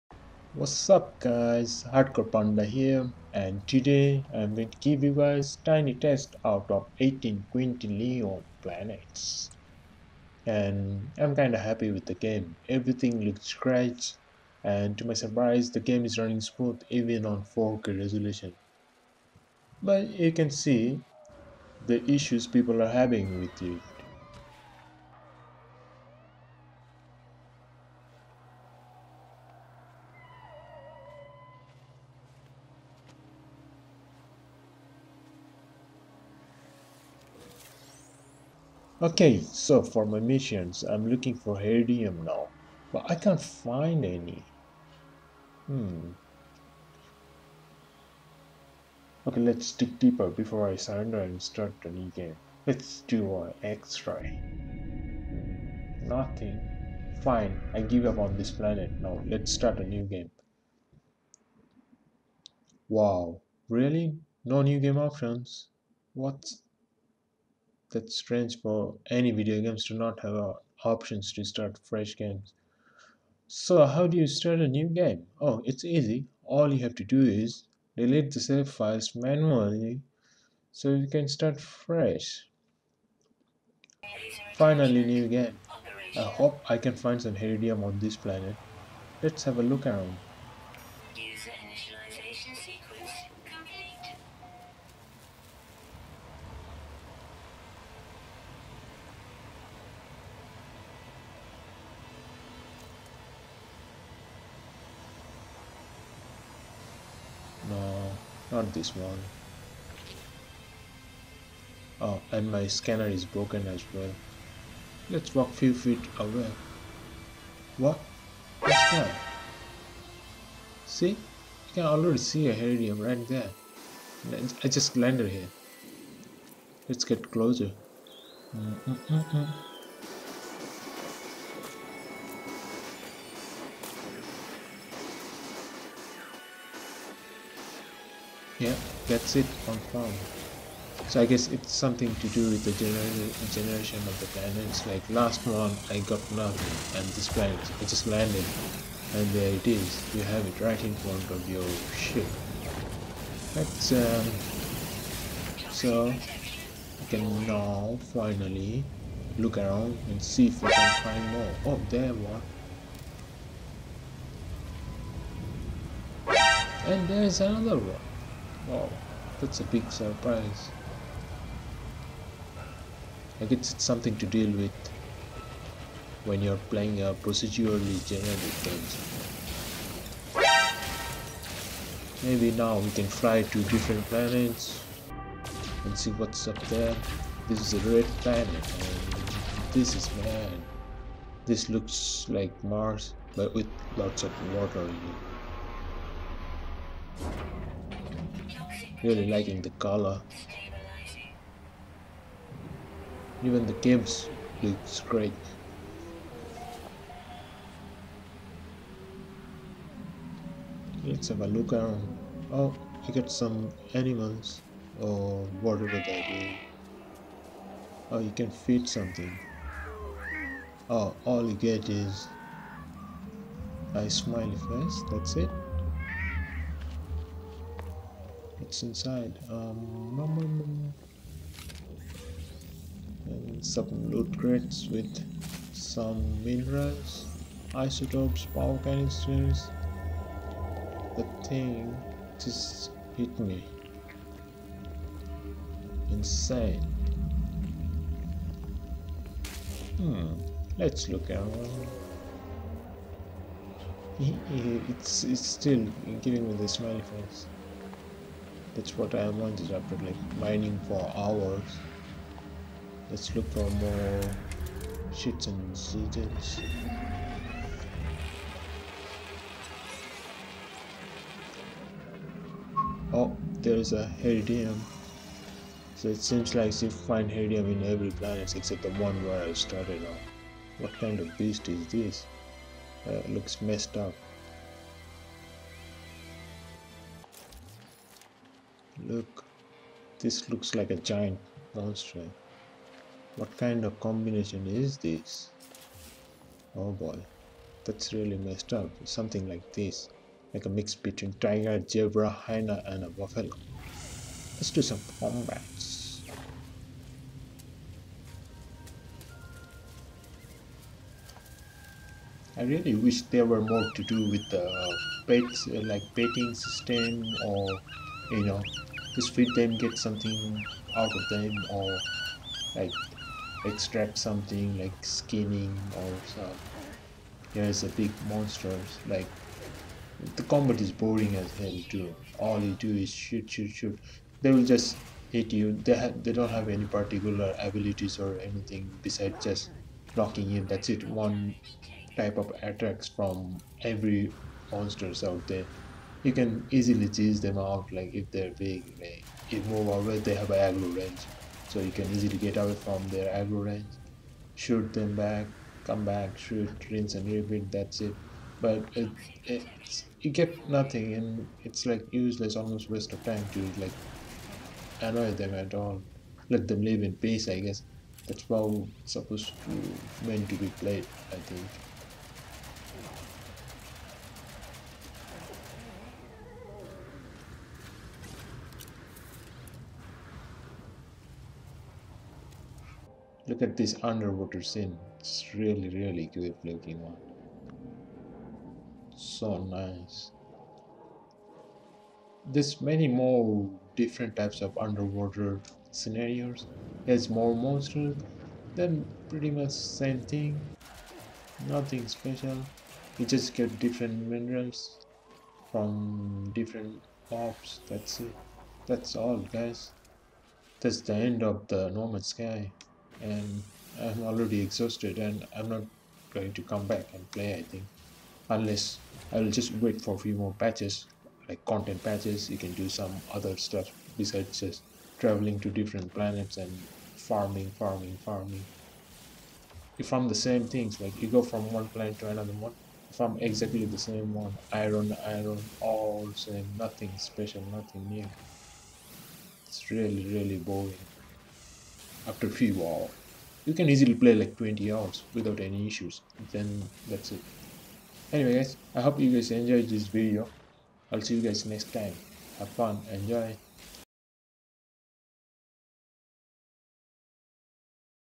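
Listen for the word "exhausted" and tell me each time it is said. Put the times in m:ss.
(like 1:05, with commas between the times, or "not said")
6:54.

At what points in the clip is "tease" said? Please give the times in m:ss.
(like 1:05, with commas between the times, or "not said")
5:47.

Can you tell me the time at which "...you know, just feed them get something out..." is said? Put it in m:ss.
5:18.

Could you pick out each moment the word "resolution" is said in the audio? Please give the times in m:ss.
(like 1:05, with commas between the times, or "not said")
0:17.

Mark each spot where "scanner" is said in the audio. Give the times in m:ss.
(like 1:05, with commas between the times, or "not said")
1:52.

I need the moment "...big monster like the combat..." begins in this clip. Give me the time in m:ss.
5:27.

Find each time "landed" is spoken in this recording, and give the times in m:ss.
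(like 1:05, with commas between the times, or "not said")
2:04, 2:28.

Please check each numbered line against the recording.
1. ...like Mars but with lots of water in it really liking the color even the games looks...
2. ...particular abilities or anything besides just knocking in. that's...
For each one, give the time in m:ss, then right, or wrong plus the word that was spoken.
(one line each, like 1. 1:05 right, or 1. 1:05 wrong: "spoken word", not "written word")
1. 3:12 right
2. 5:36 right.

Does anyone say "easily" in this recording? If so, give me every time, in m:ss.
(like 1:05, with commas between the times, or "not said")
5:46, 5:52, 7:23.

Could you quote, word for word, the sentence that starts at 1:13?
So how do you start a new game?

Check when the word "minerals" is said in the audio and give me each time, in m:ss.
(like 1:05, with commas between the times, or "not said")
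3:56, 6:44.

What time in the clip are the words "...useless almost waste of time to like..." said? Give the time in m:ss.
6:02.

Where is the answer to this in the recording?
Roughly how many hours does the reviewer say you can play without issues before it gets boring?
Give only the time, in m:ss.
7:24.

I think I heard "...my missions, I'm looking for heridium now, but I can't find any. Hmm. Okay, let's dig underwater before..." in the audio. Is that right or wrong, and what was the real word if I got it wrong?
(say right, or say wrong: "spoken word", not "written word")
wrong: "deeper", not "underwater".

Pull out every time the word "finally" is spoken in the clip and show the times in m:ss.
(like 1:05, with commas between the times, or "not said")
1:24, 2:38.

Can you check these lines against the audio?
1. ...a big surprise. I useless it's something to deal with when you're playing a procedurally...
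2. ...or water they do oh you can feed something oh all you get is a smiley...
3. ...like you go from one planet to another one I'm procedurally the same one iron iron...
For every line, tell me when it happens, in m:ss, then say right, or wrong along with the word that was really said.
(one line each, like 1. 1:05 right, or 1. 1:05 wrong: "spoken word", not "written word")
1. 2:49 wrong: "guess", not "useless"
2. 3:35 wrong: "whatever", not "water"
3. 7:10 wrong: "exactly", not "procedurally".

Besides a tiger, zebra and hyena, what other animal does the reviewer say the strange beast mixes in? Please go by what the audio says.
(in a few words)
Buffalo.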